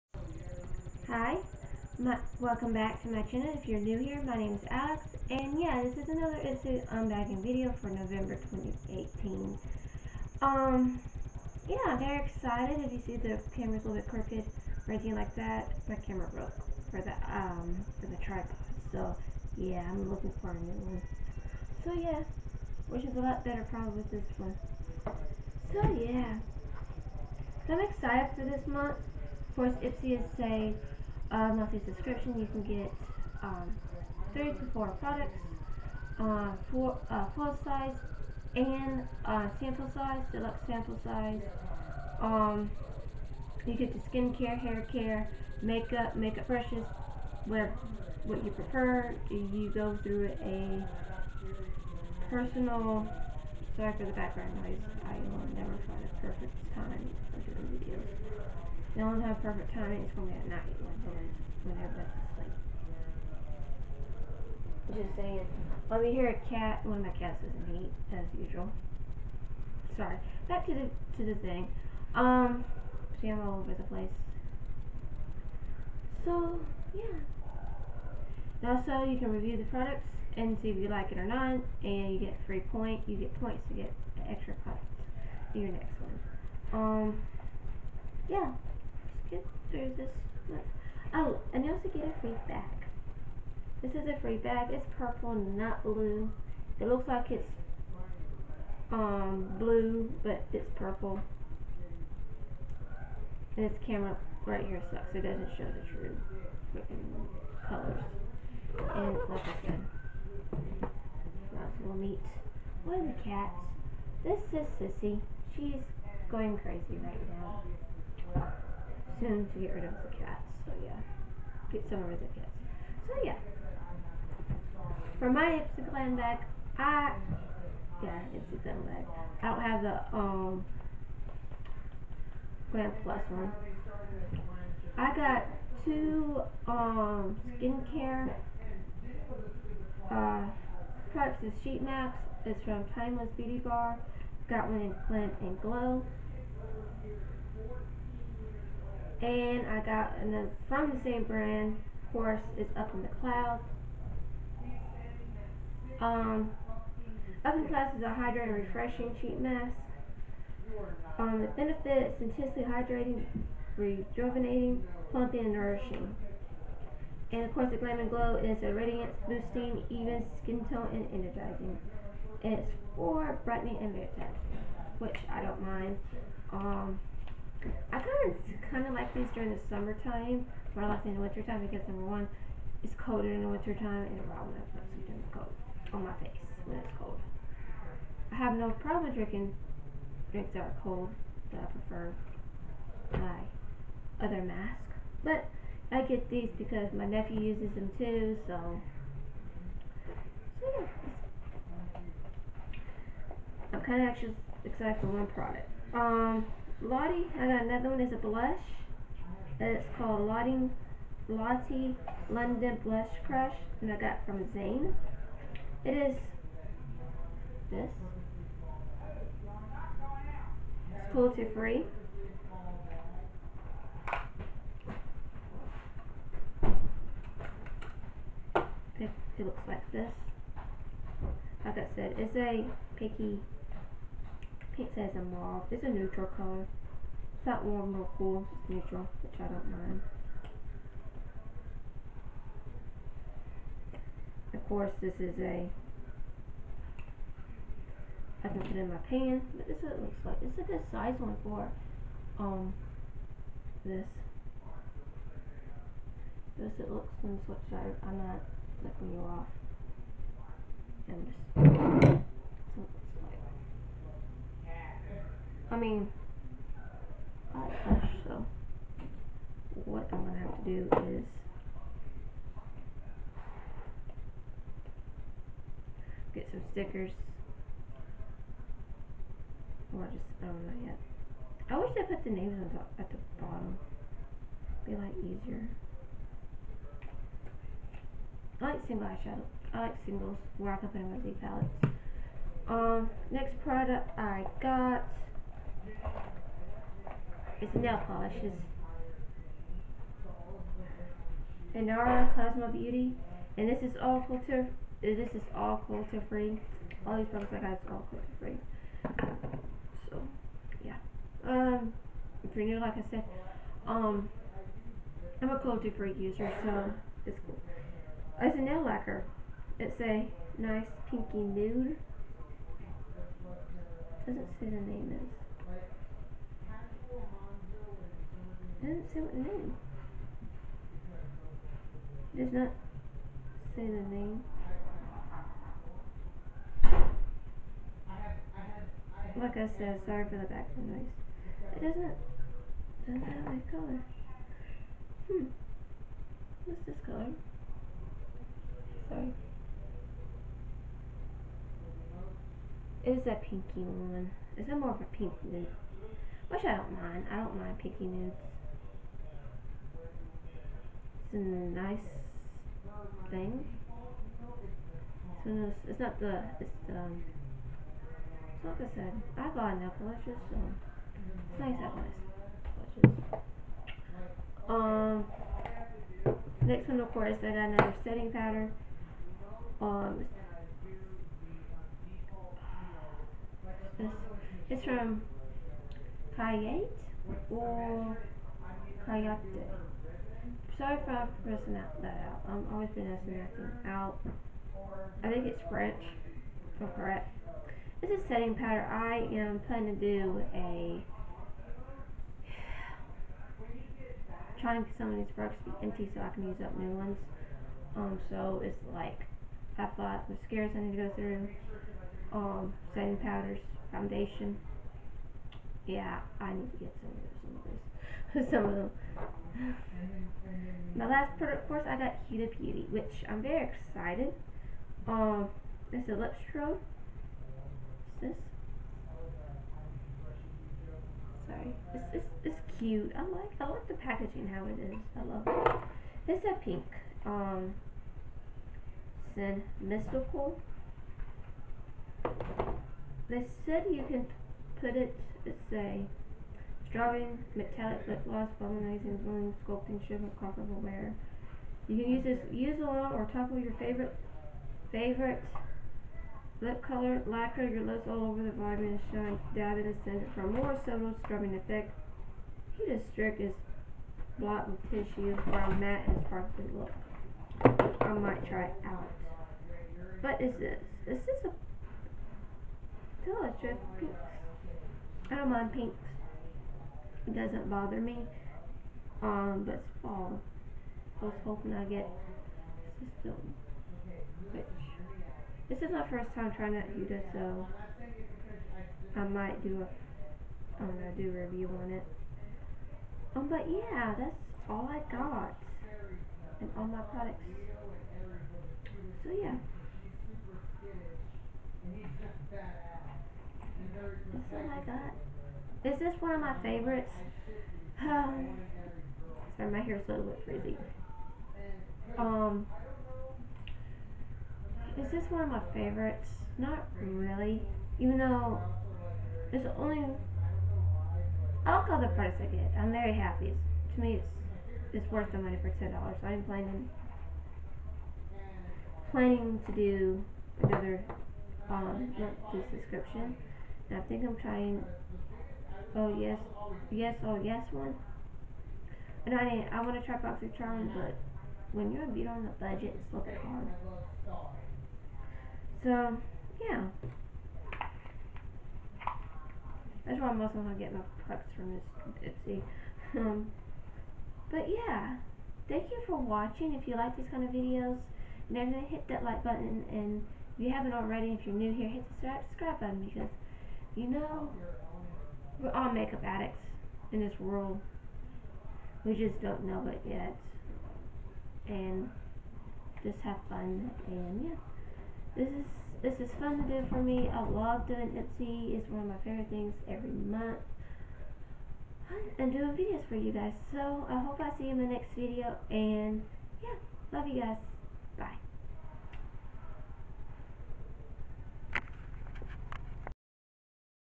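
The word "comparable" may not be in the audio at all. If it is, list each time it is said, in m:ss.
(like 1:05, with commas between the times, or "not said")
7:30.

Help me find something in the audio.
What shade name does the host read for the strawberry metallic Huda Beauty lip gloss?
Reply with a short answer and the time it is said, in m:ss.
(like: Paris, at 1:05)
mystical, at 7:19.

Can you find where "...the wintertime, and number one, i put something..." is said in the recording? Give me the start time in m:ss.
3:03.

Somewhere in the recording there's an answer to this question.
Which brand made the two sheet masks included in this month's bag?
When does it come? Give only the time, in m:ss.
2:22.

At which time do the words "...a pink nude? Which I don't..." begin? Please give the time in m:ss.
5:55.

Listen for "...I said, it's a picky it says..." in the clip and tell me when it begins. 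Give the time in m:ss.
3:51.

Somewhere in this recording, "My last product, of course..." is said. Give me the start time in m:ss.
7:00.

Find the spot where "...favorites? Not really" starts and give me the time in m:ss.
8:35.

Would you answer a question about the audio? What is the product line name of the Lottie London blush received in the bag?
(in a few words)
Blush Crush.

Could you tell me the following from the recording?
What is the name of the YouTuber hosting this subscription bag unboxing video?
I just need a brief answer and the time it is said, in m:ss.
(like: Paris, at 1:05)
Alex, at 0:04.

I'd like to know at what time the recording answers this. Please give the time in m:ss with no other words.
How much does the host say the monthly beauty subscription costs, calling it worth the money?
8:45.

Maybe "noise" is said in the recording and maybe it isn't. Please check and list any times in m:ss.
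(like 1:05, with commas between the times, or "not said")
0:54, 5:40.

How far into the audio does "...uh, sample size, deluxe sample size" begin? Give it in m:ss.
0:39.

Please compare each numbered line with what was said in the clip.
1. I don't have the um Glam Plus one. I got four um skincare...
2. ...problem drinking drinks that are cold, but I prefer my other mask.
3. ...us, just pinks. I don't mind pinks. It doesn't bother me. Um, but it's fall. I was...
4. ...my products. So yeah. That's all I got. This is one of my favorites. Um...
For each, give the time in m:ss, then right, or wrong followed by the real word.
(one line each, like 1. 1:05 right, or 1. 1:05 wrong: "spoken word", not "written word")
1. 2:09 wrong: "two", not "four"
2. 3:08 right
3. 7:53 right
4. 8:16 right.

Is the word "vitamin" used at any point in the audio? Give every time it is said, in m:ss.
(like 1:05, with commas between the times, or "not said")
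7:38.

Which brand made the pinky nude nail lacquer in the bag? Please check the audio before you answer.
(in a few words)
Inara Cosmo Beauty.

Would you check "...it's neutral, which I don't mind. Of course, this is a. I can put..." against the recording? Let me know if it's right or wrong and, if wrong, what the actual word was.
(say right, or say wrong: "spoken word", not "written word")
right.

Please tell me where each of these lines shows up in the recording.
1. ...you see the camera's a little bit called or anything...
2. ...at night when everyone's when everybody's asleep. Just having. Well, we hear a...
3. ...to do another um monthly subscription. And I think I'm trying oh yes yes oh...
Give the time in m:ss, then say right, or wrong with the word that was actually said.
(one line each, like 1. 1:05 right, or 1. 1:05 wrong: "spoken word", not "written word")
1. 0:12 wrong: "crooked", not "called"
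2. 1:00 wrong: "saying", not "having"
3. 8:49 right.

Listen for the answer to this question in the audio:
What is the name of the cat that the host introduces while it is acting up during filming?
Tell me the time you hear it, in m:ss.
1:54.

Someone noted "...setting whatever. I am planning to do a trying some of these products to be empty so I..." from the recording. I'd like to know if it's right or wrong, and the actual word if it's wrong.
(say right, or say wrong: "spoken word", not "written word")
wrong: "powder", not "whatever".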